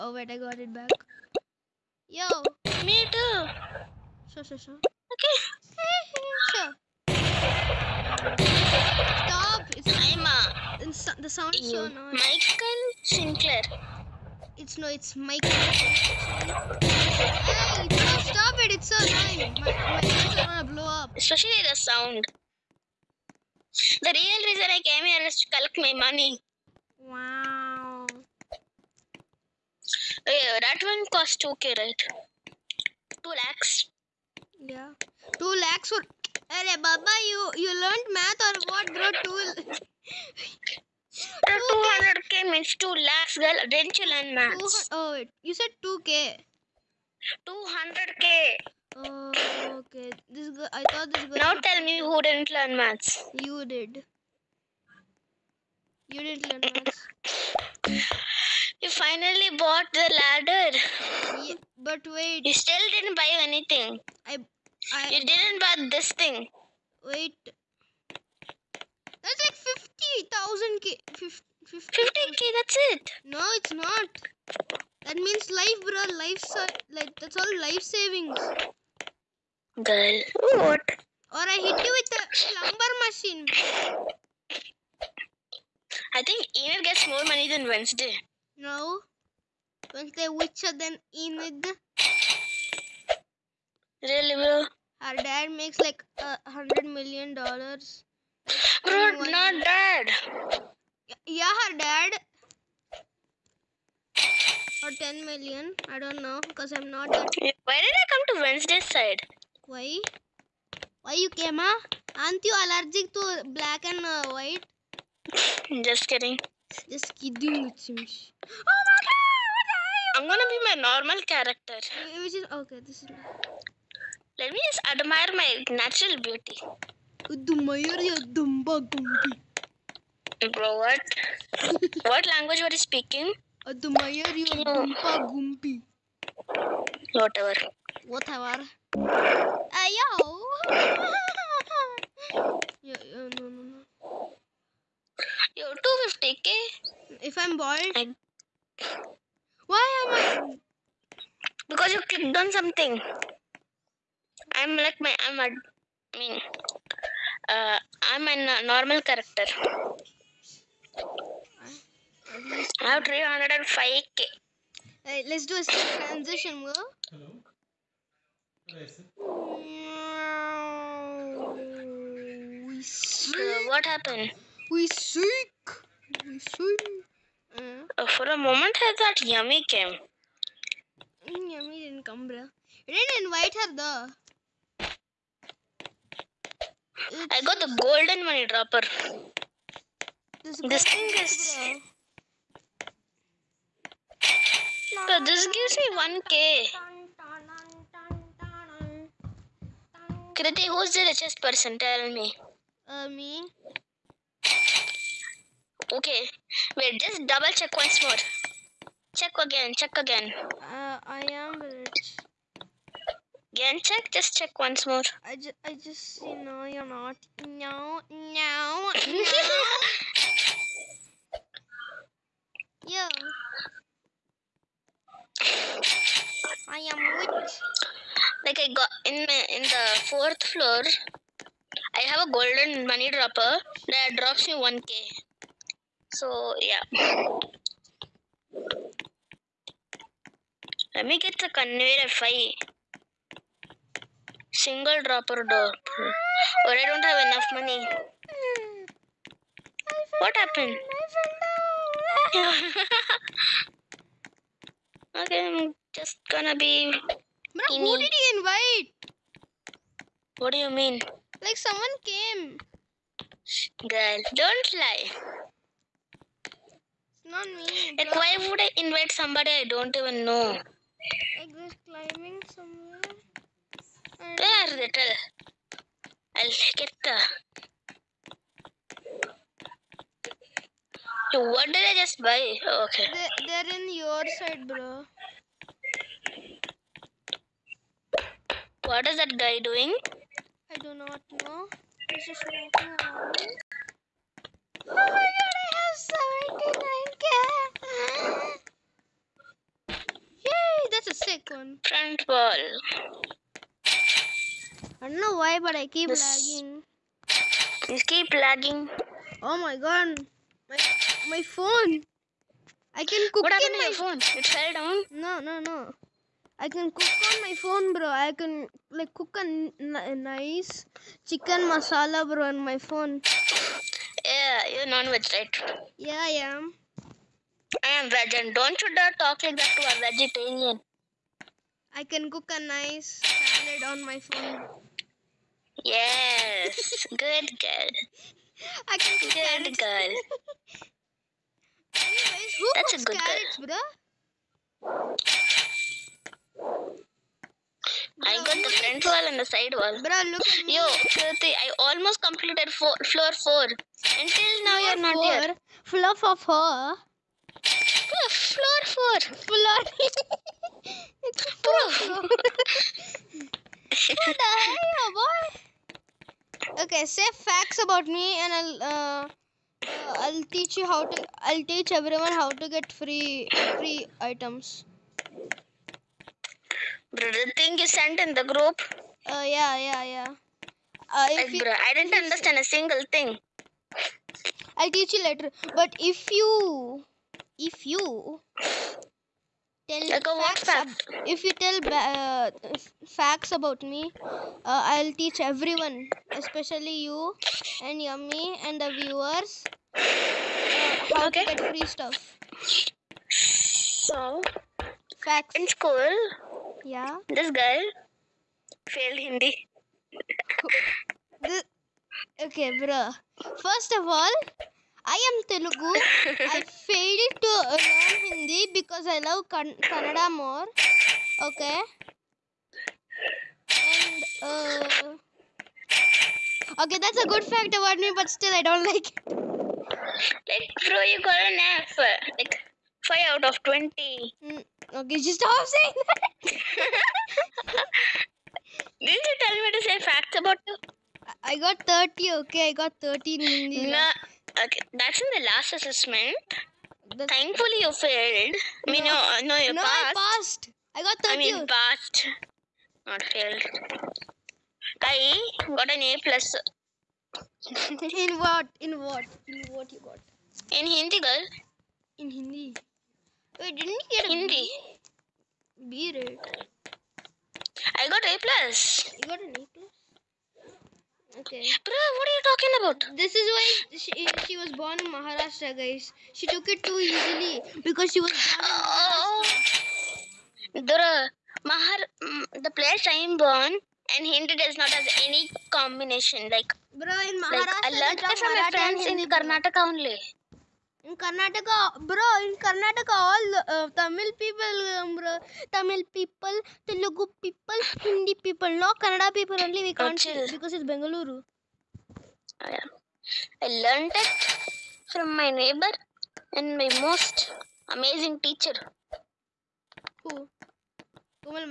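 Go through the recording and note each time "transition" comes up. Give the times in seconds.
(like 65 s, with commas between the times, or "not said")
166 s.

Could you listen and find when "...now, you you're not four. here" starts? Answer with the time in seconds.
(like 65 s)
354 s.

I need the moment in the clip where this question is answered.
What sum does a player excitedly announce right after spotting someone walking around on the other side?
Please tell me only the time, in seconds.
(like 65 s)
298 s.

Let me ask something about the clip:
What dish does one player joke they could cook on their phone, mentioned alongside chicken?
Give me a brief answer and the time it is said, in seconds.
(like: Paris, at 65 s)
chicken masala, at 321 s.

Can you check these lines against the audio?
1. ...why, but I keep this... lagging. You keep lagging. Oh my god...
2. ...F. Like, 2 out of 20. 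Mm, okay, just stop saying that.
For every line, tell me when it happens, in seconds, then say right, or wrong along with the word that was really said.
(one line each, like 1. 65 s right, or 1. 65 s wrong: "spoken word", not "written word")
1. 305 s right
2. 431 s wrong: "5", not "2".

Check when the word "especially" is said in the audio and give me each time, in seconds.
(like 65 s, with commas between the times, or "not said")
21 s, 396 s.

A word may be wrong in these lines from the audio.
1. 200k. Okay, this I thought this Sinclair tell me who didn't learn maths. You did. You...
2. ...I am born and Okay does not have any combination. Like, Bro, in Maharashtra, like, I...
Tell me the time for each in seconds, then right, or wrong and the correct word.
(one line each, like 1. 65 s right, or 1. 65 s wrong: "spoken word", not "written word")
1. 47 s wrong: "Now", not "Sinclair"
2. 483 s wrong: "Hindi", not "Okay".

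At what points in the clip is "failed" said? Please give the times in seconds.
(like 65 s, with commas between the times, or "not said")
408 s, 416 s, 447 s, 453 s.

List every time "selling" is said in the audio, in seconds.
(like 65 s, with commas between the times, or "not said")
not said.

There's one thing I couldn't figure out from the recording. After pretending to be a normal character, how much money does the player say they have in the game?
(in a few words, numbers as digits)
305k.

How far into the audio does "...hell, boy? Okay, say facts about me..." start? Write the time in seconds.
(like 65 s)
364 s.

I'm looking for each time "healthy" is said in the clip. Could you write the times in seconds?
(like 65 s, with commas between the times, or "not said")
not said.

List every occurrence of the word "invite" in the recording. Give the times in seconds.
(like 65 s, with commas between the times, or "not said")
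183 s, 258 s, 268 s.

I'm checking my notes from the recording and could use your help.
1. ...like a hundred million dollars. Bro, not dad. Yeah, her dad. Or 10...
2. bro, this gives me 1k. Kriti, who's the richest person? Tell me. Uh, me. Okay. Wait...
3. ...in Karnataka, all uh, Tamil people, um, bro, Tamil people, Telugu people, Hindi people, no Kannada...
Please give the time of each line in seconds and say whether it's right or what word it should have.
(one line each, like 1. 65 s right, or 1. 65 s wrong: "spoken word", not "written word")
1. 95 s right
2. 195 s right
3. 492 s right.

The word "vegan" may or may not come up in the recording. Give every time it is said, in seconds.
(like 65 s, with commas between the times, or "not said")
328 s.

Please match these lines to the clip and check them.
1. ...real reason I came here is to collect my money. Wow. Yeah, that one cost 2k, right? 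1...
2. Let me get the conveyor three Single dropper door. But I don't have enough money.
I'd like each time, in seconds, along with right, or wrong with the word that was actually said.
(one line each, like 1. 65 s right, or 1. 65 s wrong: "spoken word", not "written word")
1. 24 s wrong: "2", not "1"
2. 240 s wrong: "five", not "three".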